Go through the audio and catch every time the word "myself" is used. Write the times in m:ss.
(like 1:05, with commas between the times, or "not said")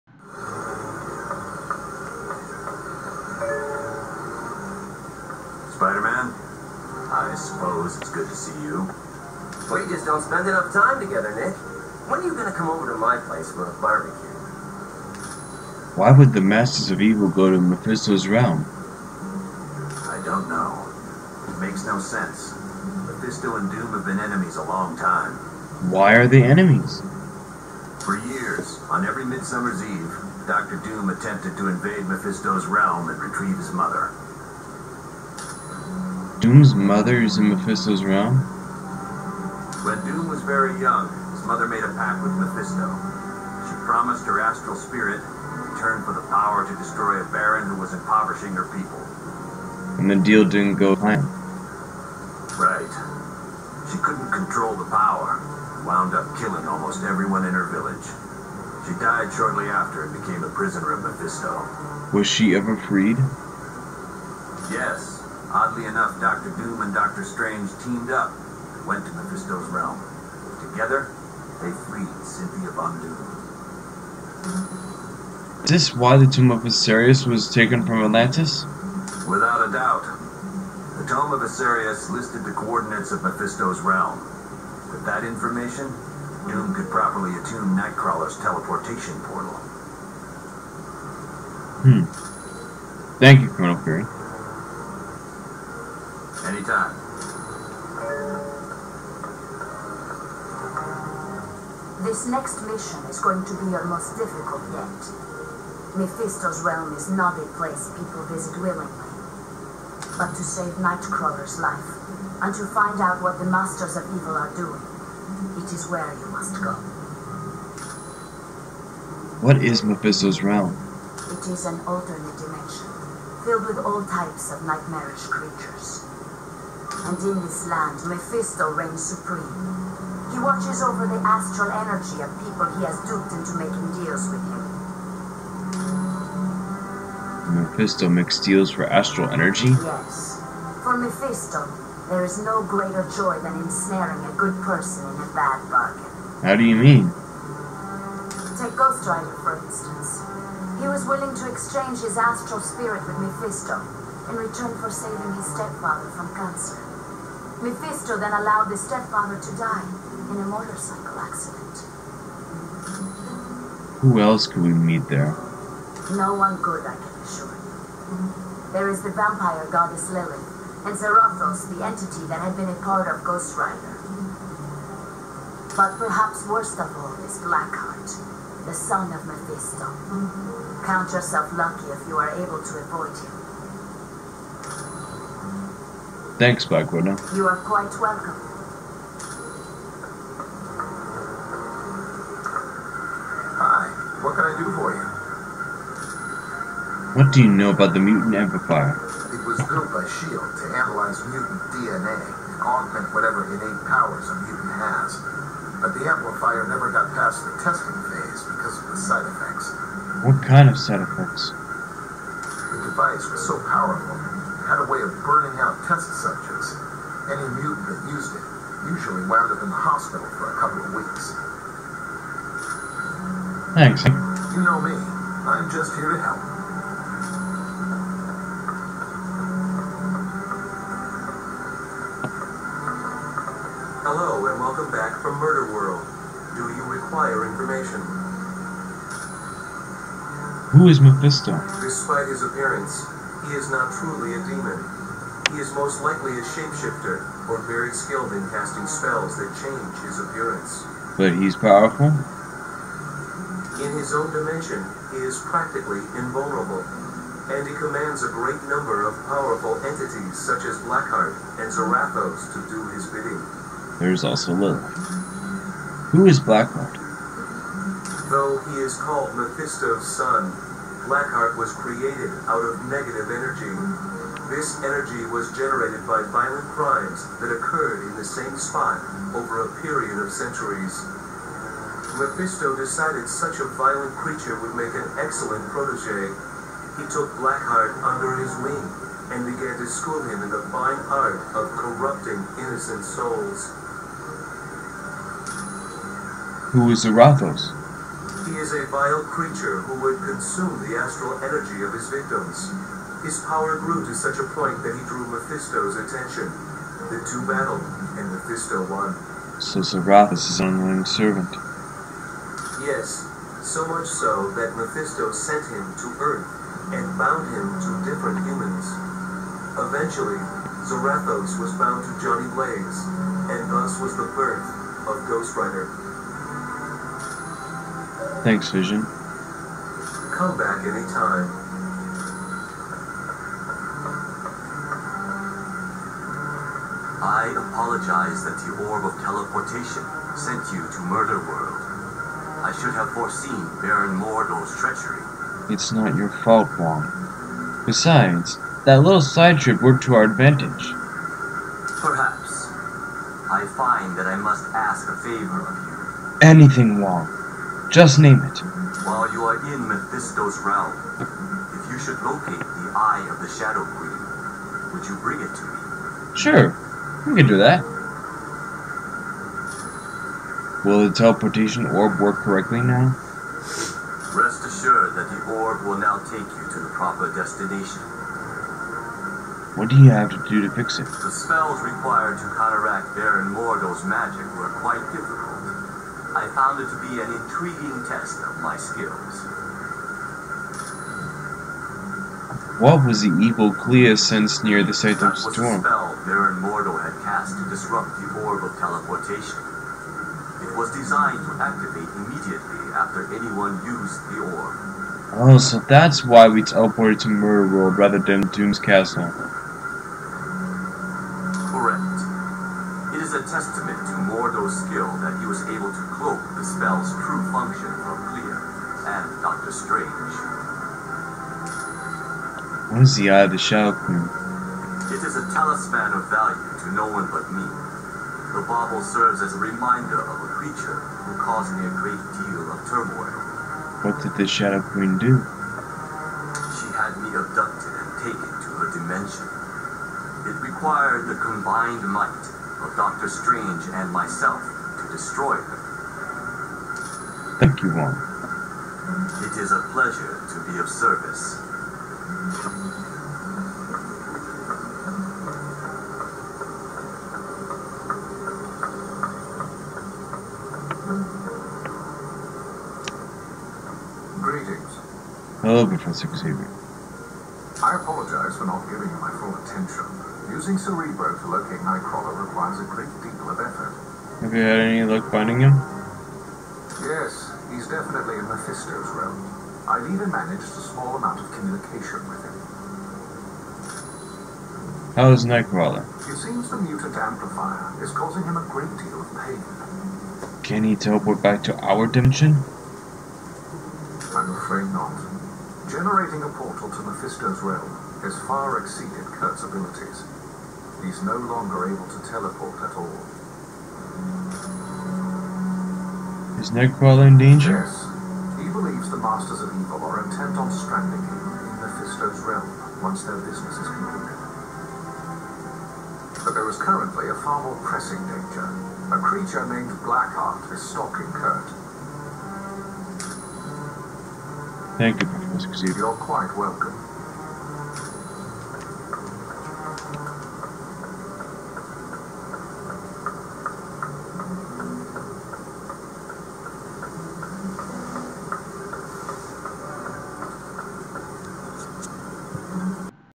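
7:24.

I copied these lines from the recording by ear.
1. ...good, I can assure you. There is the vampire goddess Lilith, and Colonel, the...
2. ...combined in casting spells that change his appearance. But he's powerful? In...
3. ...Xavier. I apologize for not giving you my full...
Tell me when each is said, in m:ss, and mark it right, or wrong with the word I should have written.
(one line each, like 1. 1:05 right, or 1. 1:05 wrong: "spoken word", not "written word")
1. 2:46 wrong: "Zarathos", not "Colonel"
2. 4:07 wrong: "skilled", not "combined"
3. 7:46 right.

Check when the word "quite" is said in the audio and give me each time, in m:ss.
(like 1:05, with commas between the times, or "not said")
3:07, 6:24, 8:46.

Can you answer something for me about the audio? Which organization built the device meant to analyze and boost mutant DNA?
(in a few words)
S.H.I.E.L.D.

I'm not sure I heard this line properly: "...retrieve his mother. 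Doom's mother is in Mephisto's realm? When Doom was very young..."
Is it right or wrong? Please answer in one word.
right.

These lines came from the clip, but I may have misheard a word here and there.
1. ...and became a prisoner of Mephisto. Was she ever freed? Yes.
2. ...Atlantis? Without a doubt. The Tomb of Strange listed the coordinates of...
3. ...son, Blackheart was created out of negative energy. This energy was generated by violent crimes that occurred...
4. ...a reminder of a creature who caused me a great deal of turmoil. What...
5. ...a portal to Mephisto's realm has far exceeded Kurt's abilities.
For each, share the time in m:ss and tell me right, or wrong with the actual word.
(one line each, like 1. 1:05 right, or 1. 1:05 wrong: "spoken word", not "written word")
1. 1:00 right
2. 1:18 wrong: "Asterius", not "Strange"
3. 4:30 right
4. 7:09 right
5. 8:16 right.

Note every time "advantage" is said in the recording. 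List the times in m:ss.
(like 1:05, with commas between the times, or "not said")
5:50.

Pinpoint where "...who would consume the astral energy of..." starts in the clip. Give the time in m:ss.
4:59.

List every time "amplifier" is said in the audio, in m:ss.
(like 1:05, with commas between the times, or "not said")
3:18, 3:26, 8:07.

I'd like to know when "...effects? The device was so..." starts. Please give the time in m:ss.
3:31.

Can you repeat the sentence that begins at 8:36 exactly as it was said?
But there is currently a far more pressing danger.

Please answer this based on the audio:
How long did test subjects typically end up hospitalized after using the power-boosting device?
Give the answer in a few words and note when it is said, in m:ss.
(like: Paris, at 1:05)
A couple of weeks, at 3:40.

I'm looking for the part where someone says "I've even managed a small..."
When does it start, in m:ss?
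7:59.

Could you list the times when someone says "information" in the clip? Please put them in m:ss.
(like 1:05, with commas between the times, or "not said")
1:25, 3:57.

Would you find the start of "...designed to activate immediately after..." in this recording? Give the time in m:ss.
6:40.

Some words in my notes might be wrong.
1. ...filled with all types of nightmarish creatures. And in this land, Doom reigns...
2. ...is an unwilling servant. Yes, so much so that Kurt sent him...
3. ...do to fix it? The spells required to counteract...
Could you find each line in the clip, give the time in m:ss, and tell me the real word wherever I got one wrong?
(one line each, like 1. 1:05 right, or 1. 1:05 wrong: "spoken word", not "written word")
1. 2:03 wrong: "Mephisto", not "Doom"
2. 5:10 wrong: "Mephisto", not "Kurt"
3. 6:20 right.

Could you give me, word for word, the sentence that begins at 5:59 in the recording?
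While you are in Mephisto's realm, if you should locate the Eye of the Shadow Queen, would you bring it to me?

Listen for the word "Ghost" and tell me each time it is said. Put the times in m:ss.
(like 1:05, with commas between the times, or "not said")
2:28, 2:53, 5:25.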